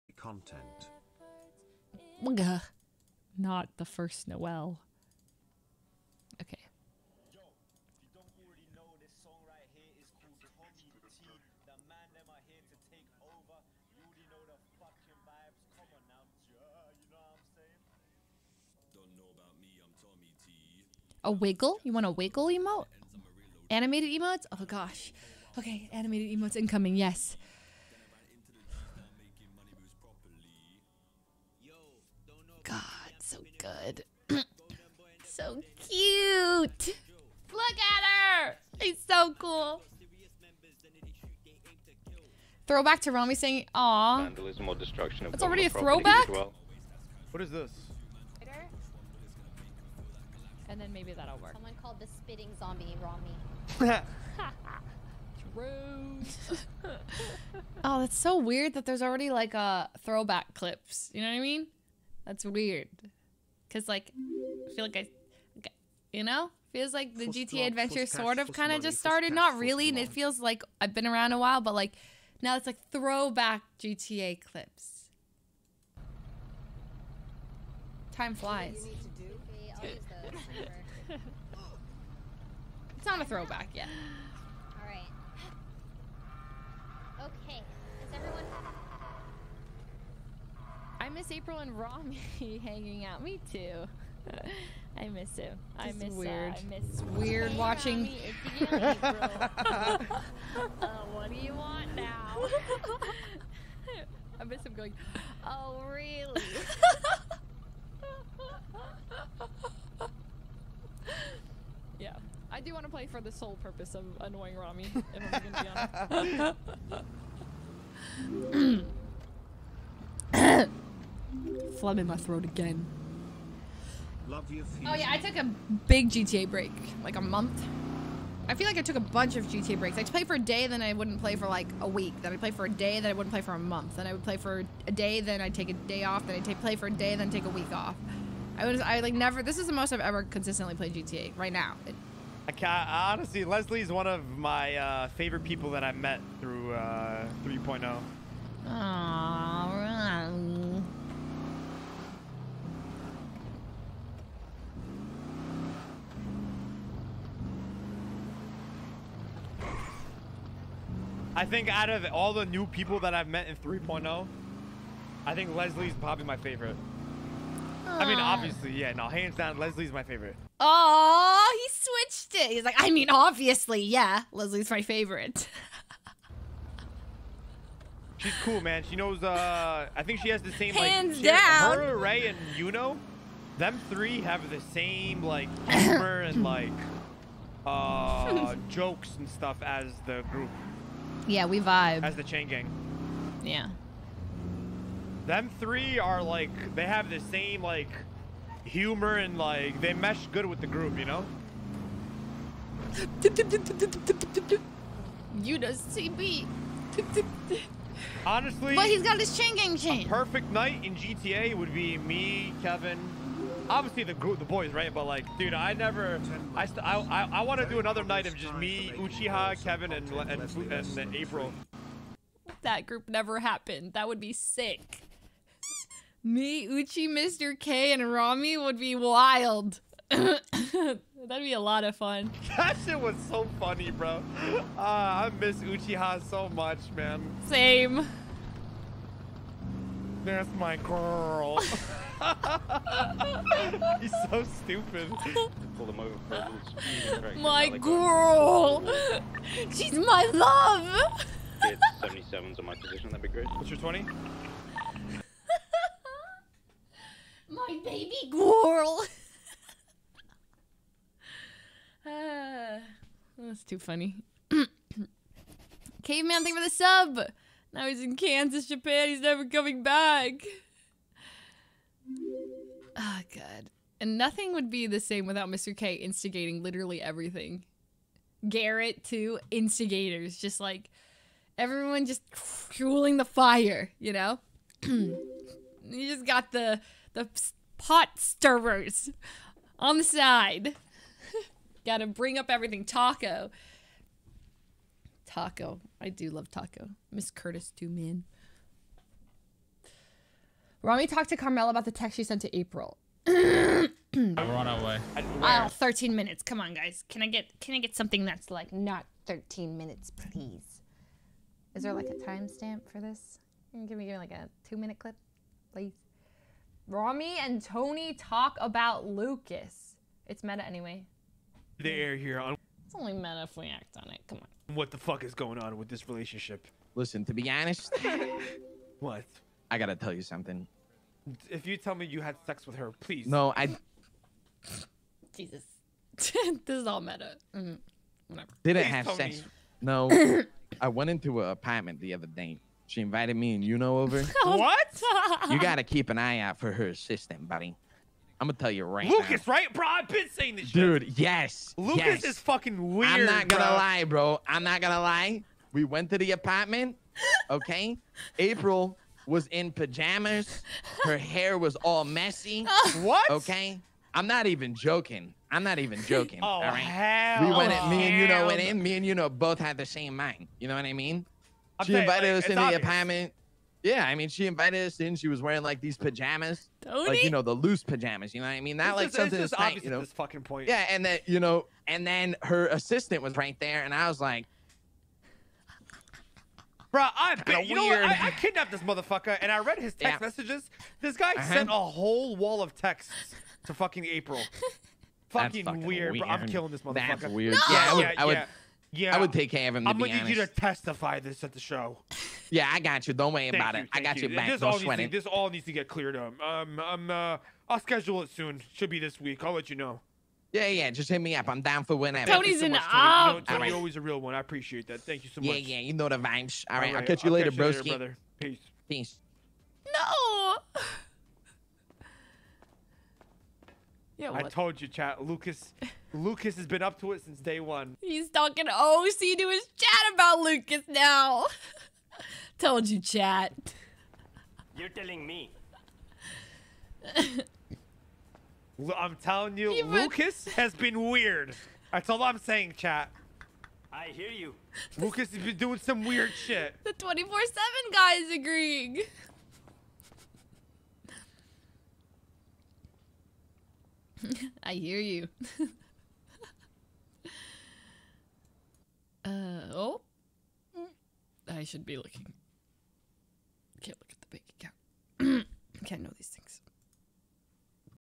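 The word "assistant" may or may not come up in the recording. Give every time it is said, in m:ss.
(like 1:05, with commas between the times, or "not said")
5:46, 6:22.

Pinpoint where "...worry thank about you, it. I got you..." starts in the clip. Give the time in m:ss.
6:43.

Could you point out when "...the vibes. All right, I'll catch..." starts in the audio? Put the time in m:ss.
6:56.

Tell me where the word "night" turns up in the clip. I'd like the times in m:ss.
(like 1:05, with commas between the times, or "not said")
3:30, 3:38.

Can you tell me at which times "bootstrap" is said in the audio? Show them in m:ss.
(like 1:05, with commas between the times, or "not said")
not said.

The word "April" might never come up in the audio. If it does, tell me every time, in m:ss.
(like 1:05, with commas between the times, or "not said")
1:31, 3:41, 5:02, 5:58, 6:34.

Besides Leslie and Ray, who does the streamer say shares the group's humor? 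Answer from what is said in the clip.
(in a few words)
Yuno.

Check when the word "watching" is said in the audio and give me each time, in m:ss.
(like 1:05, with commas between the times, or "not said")
1:37.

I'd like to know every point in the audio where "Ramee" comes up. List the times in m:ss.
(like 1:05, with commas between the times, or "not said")
3:48, 5:00, 5:16.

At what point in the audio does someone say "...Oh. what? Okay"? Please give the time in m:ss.
6:02.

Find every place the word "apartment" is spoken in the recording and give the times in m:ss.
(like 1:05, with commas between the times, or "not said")
5:41, 5:56, 6:12.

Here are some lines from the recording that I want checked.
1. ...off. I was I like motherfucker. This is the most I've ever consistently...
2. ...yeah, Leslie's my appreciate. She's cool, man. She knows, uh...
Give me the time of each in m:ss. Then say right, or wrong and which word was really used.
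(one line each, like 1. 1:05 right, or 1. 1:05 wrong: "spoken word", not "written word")
1. 2:17 wrong: "never", not "motherfucker"
2. 2:53 wrong: "favorite", not "appreciate".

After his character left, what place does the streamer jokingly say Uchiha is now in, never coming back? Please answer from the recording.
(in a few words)
Kansas, Japan.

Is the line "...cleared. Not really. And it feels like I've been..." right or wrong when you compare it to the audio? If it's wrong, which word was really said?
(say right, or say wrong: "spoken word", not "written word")
wrong: "started", not "cleared".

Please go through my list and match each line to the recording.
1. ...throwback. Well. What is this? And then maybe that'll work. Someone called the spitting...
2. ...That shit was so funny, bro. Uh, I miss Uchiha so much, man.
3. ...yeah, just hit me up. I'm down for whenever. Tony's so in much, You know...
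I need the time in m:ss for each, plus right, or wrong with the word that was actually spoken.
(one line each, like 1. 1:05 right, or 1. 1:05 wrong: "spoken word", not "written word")
1. 0:45 right
2. 3:52 right
3. 6:50 right.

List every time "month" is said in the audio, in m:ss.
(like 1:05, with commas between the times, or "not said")
2:07, 2:13.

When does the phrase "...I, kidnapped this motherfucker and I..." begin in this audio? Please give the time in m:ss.
6:28.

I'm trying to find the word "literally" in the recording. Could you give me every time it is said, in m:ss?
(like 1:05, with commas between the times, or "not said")
4:36.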